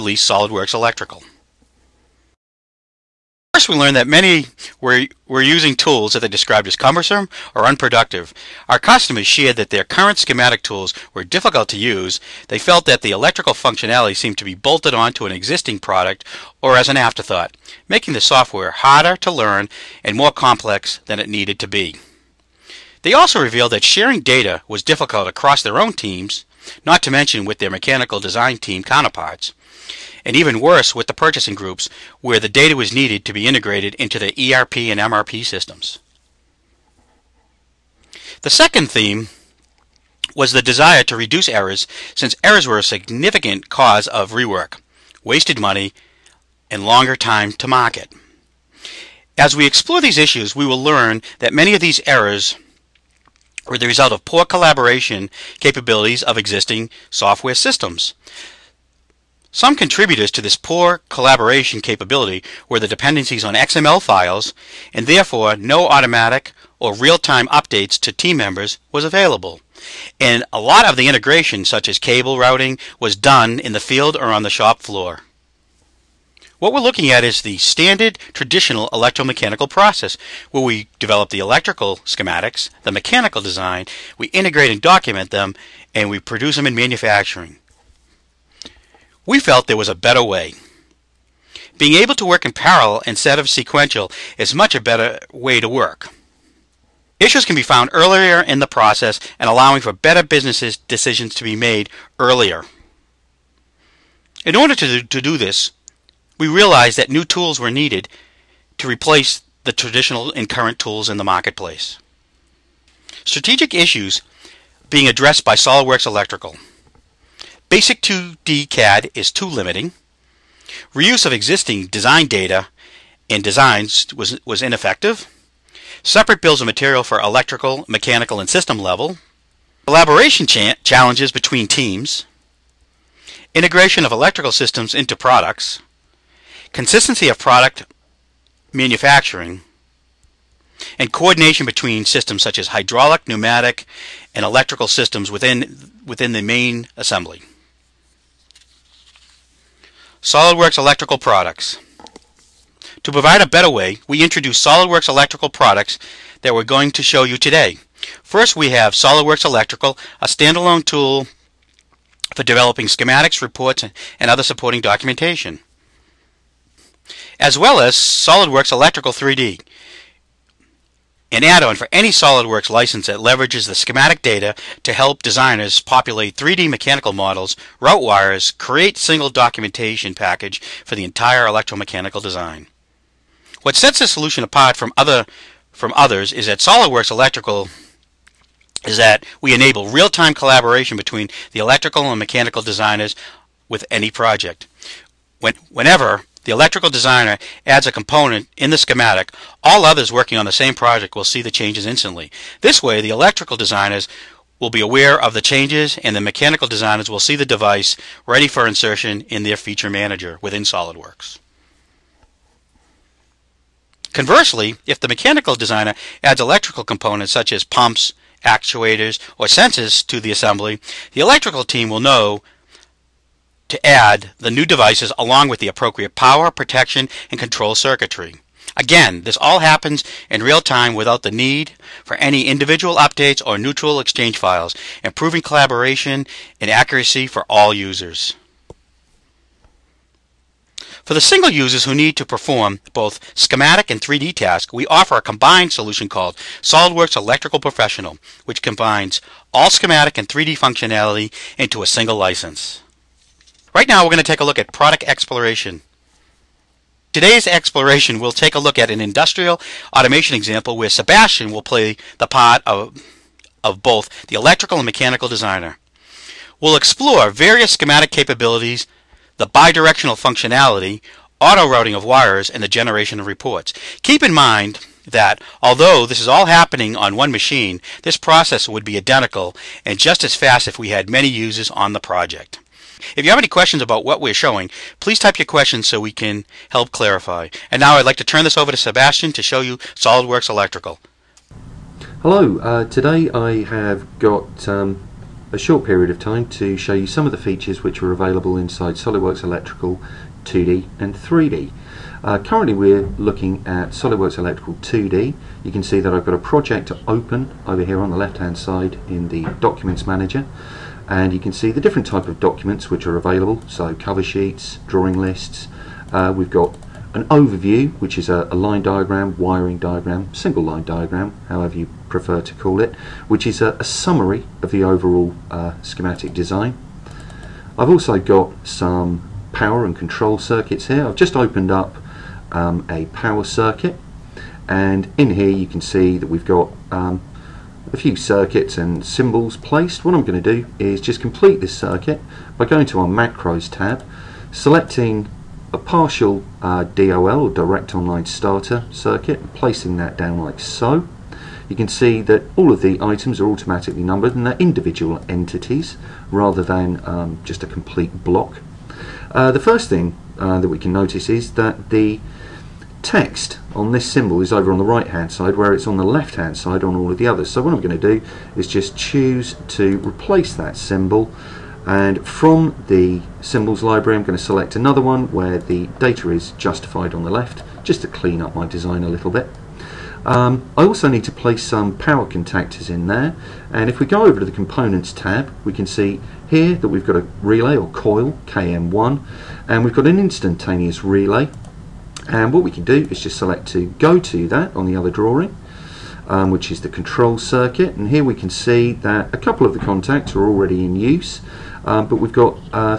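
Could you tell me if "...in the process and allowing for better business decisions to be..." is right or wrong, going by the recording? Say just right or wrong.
right.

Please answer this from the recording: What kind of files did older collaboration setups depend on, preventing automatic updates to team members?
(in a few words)
XML files.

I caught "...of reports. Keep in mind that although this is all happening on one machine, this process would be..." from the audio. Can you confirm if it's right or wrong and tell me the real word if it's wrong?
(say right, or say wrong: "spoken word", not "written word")
right.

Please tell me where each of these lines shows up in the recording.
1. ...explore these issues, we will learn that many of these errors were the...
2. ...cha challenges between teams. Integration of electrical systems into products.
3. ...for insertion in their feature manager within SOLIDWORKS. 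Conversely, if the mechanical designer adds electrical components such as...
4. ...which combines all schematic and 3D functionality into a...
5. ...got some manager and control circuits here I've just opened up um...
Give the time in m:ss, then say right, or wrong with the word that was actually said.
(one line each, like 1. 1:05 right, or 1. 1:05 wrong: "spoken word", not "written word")
1. 0:49 right
2. 2:10 right
3. 3:28 right
4. 4:08 right
5. 5:28 wrong: "power", not "manager".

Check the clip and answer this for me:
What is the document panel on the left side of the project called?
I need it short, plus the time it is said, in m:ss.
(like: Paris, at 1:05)
Documents Manager, at 5:09.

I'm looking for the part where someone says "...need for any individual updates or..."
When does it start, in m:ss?
3:51.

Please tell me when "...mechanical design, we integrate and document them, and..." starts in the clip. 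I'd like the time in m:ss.
1:22.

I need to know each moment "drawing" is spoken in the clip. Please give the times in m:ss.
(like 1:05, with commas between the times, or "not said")
5:14, 6:35.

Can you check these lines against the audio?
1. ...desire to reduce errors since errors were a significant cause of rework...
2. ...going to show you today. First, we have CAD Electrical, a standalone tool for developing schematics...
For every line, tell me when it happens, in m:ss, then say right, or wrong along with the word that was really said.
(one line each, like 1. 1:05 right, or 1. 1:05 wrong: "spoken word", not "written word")
1. 0:40 right
2. 2:36 wrong: "SOLIDWORKS", not "CAD".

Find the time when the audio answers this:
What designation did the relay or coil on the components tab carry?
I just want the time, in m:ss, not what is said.
6:28.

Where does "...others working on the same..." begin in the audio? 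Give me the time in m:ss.
3:19.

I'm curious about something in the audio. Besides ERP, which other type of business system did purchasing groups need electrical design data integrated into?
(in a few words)
MRP.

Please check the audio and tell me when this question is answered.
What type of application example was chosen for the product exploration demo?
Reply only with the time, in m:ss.
4:19.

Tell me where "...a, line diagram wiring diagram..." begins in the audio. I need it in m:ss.
5:18.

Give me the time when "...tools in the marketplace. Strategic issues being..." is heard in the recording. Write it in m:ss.
1:50.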